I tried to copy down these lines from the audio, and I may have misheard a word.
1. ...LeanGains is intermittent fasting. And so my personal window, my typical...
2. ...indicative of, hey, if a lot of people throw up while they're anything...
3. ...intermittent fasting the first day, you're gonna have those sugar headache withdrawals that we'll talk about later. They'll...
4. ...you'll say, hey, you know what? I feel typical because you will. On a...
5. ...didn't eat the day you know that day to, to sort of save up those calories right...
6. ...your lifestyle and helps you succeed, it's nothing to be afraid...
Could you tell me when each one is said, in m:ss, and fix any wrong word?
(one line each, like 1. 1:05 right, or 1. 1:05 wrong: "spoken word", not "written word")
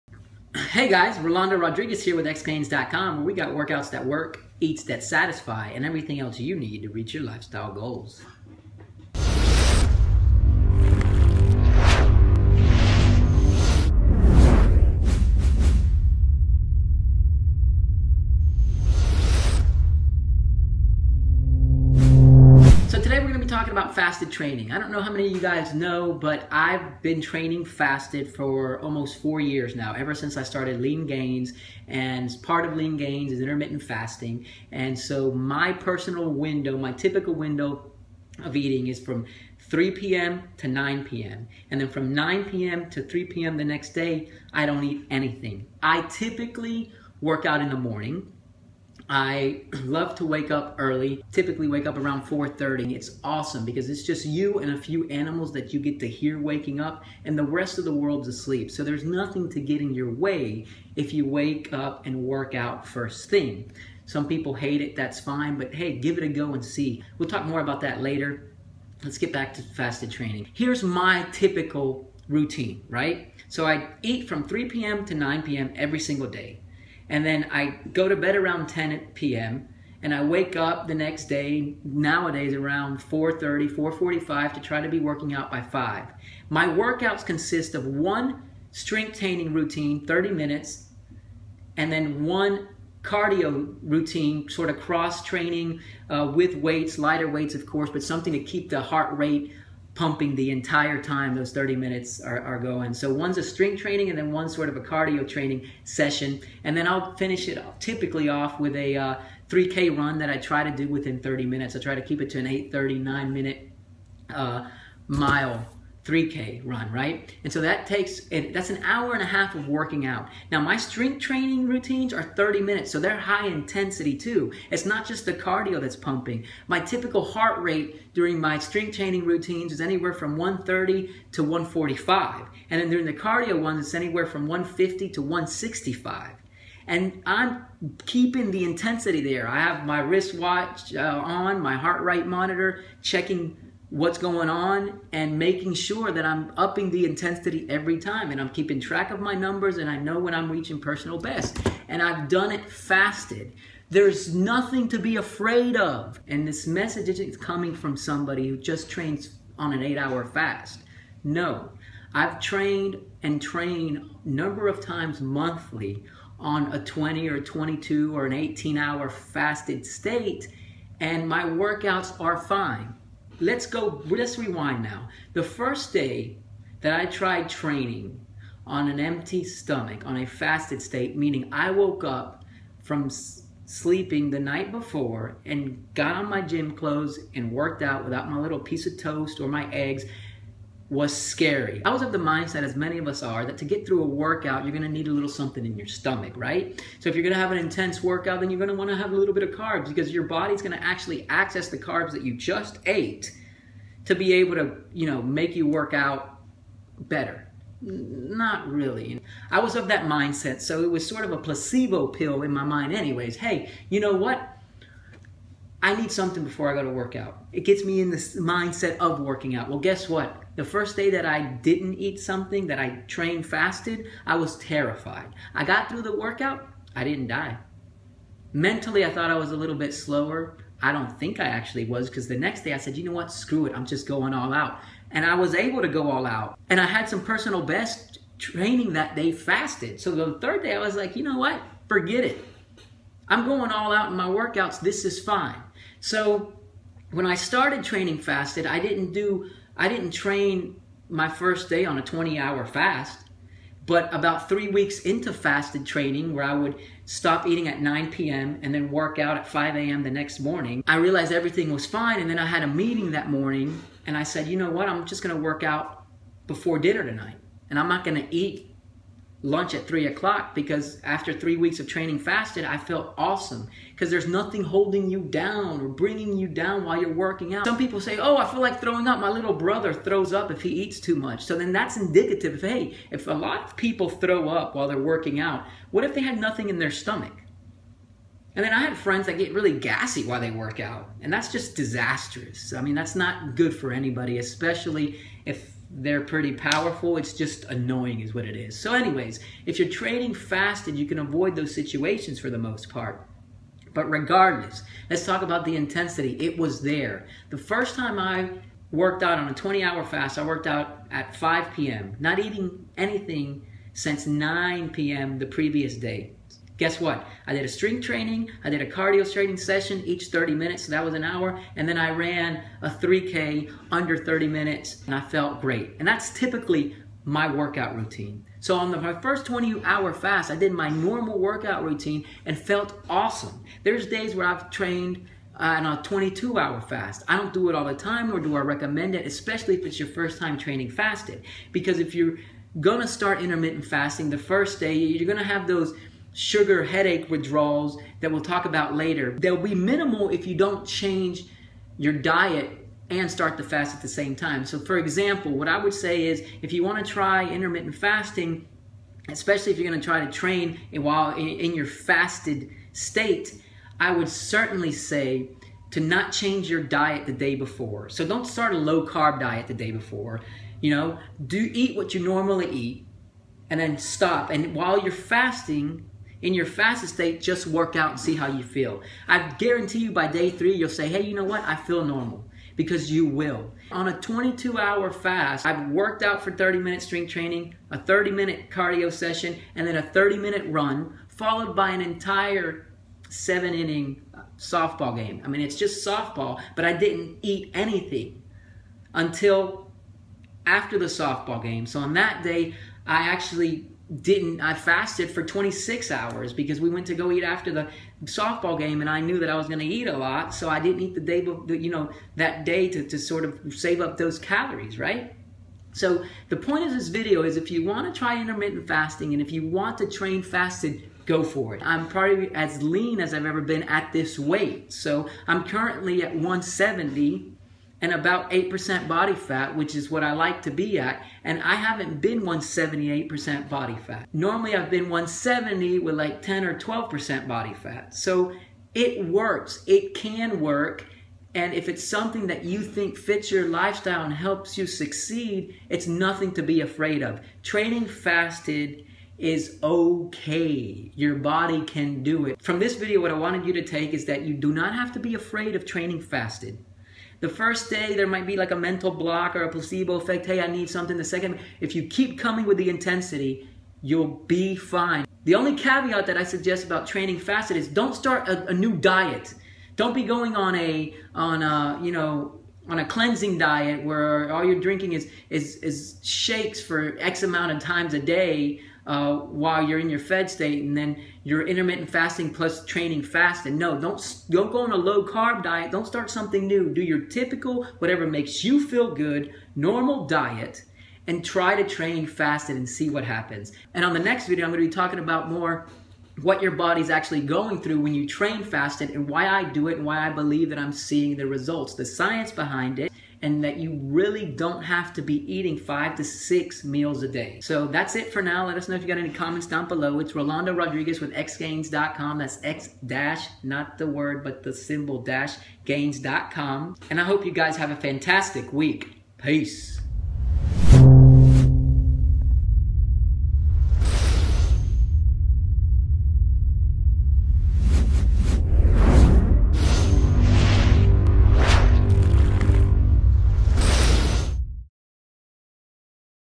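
1. 0:32 right
2. 4:41 wrong: "working", not "anything"
3. 5:43 right
4. 6:20 wrong: "normal", not "typical"
5. 6:50 right
6. 7:23 right.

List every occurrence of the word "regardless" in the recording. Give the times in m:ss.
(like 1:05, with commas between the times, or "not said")
5:04.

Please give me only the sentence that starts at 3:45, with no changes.
I got through the workout, I didn't die.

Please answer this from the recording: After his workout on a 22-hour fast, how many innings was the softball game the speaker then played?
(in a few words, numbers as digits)
seven.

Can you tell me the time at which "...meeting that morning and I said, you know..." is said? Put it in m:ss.
4:22.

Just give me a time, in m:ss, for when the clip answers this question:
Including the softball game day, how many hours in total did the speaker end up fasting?
6:45.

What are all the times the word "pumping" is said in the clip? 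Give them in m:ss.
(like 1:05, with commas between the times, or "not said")
1:39, 2:05.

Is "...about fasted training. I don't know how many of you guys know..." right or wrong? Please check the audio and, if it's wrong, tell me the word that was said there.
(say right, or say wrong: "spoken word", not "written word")
right.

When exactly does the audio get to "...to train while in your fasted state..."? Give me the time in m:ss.
6:00.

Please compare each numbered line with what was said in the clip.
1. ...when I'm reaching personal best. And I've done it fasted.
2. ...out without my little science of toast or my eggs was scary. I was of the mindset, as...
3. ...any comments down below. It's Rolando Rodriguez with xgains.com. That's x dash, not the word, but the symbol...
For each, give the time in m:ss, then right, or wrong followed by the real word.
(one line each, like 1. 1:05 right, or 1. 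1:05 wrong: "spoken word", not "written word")
1. 2:30 right
2. 3:07 wrong: "piece", not "science"
3. 8:29 right.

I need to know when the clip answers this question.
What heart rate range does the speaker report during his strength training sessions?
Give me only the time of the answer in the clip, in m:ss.
2:10.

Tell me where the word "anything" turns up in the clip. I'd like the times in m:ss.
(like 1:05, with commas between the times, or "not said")
0:45, 5:12, 6:37.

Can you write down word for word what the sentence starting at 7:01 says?
I'm probably as lean as I've ever been at this weight.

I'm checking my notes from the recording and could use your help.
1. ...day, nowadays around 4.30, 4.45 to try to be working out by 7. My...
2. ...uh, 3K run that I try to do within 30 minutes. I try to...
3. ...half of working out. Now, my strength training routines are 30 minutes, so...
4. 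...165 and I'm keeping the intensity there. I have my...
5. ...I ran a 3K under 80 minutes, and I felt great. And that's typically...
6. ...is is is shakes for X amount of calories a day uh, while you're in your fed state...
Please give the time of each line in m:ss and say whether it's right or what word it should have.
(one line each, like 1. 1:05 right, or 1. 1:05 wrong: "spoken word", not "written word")
1. 1:21 wrong: "5", not "7"
2. 1:48 right
3. 1:59 right
4. 2:15 right
5. 5:21 wrong: "30", not "80"
6. 7:55 wrong: "times", not "calories".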